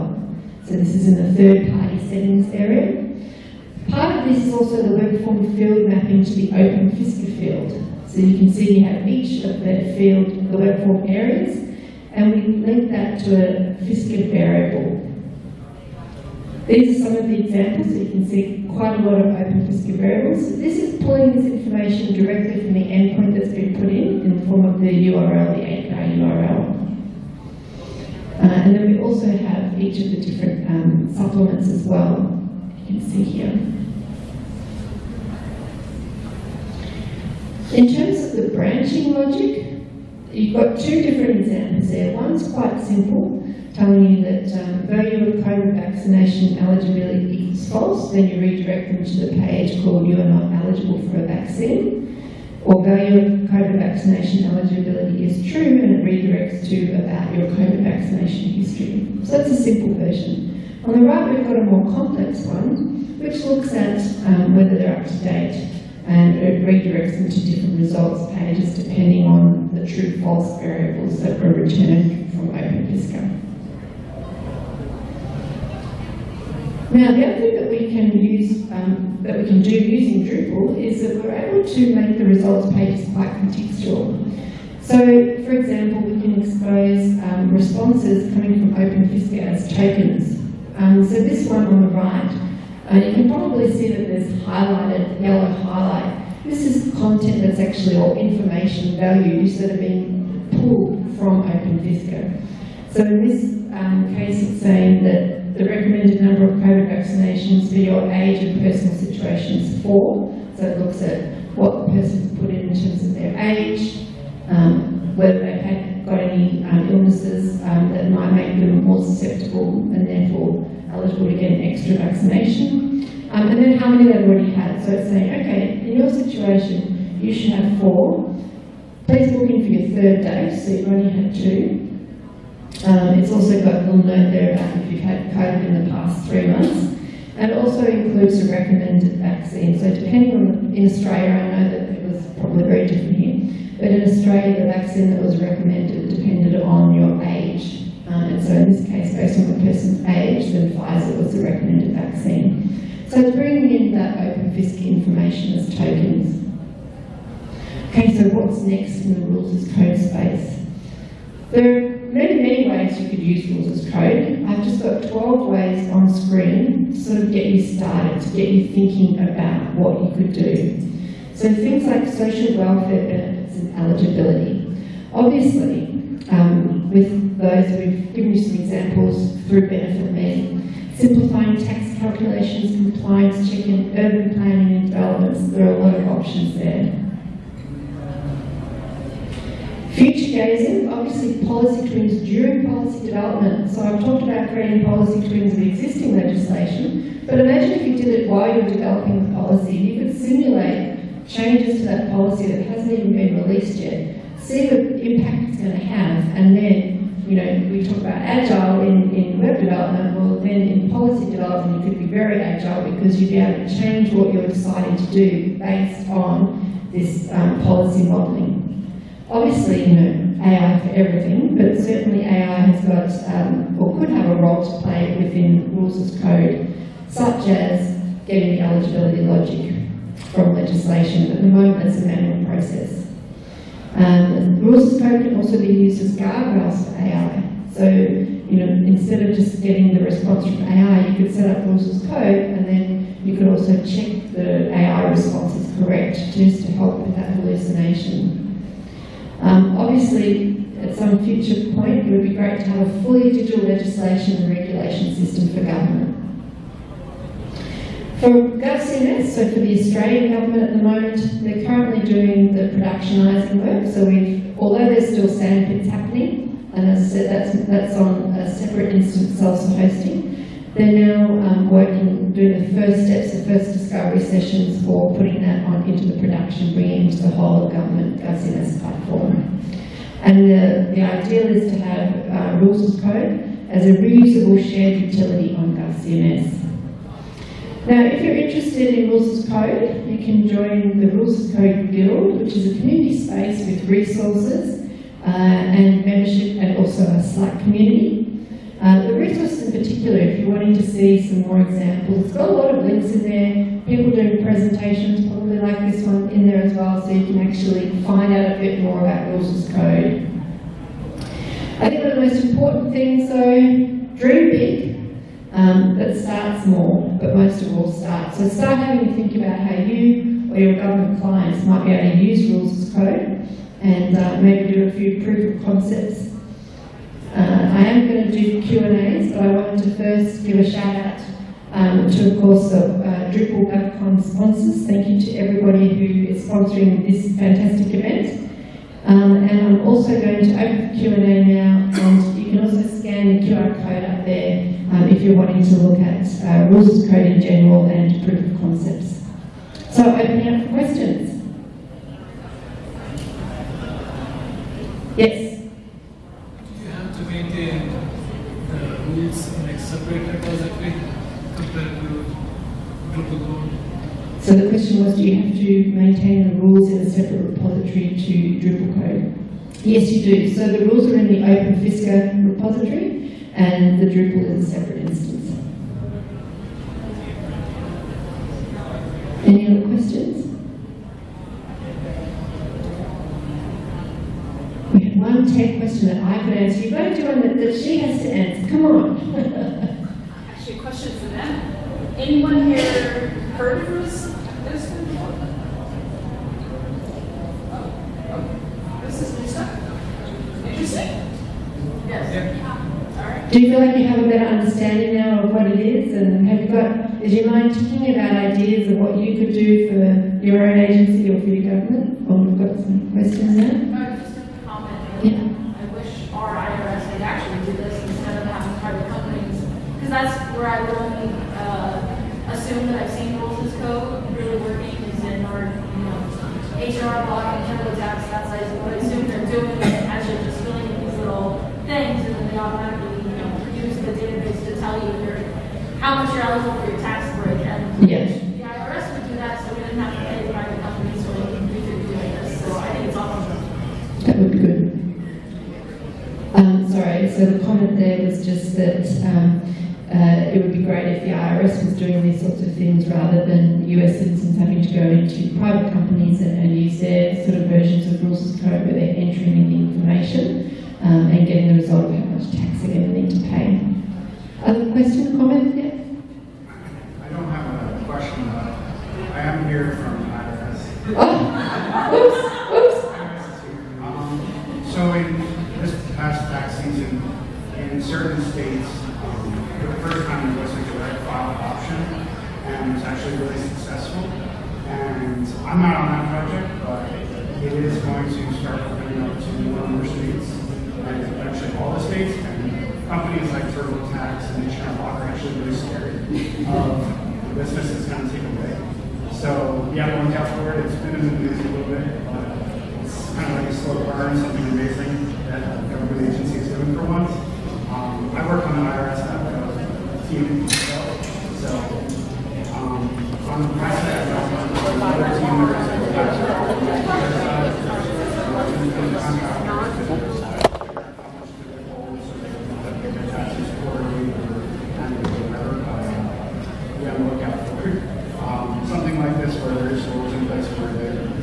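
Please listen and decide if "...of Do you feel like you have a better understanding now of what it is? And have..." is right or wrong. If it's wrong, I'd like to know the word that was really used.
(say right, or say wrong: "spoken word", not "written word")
right.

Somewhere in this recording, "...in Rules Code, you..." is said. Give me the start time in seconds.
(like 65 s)
288 s.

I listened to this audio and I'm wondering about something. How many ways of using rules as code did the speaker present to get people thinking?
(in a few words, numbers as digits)
12.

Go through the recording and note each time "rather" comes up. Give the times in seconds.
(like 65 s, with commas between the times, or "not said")
453 s.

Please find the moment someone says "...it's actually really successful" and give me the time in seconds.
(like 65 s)
482 s.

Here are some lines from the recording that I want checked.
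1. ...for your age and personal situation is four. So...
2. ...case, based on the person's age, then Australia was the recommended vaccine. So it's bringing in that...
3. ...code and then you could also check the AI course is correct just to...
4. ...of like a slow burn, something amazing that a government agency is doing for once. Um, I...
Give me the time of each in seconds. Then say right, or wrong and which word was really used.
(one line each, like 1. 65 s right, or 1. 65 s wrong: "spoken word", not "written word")
1. 107 s right
2. 148 s wrong: "Pfizer", not "Australia"
3. 242 s wrong: "response", not "course"
4. 503 s right.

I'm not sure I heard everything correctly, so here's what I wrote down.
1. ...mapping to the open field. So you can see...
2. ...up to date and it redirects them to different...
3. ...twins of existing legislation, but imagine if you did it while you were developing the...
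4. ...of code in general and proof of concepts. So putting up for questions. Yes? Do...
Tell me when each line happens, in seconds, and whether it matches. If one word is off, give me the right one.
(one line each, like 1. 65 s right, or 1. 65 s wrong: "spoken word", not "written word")
1. 5 s right
2. 64 s right
3. 195 s right
4. 347 s wrong: "opening", not "putting".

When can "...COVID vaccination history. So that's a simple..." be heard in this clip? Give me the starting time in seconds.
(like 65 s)
57 s.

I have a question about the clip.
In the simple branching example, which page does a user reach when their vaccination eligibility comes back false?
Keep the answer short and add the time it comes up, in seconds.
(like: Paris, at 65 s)
You are not eligible for a vaccine, at 50 s.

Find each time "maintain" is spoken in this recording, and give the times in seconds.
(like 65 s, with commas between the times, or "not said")
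357 s, 365 s.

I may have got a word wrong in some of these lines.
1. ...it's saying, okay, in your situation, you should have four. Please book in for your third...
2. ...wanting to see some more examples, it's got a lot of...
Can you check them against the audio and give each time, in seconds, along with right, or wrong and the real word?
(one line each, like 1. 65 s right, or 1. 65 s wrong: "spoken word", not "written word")
1. 124 s right
2. 300 s right.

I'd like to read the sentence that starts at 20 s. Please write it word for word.
this is pulling this information directly from the endpoint that's been put in, in the form of the URL, the API URL.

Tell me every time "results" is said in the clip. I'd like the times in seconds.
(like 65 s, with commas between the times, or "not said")
67 s, 82 s, 461 s.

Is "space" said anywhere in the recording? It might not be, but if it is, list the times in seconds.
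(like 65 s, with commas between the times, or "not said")
159 s, 293 s.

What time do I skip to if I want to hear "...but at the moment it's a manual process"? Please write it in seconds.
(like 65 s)
231 s.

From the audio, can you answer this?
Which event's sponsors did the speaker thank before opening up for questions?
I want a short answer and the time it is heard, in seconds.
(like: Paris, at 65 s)
Drupal GovCon, at 333 s.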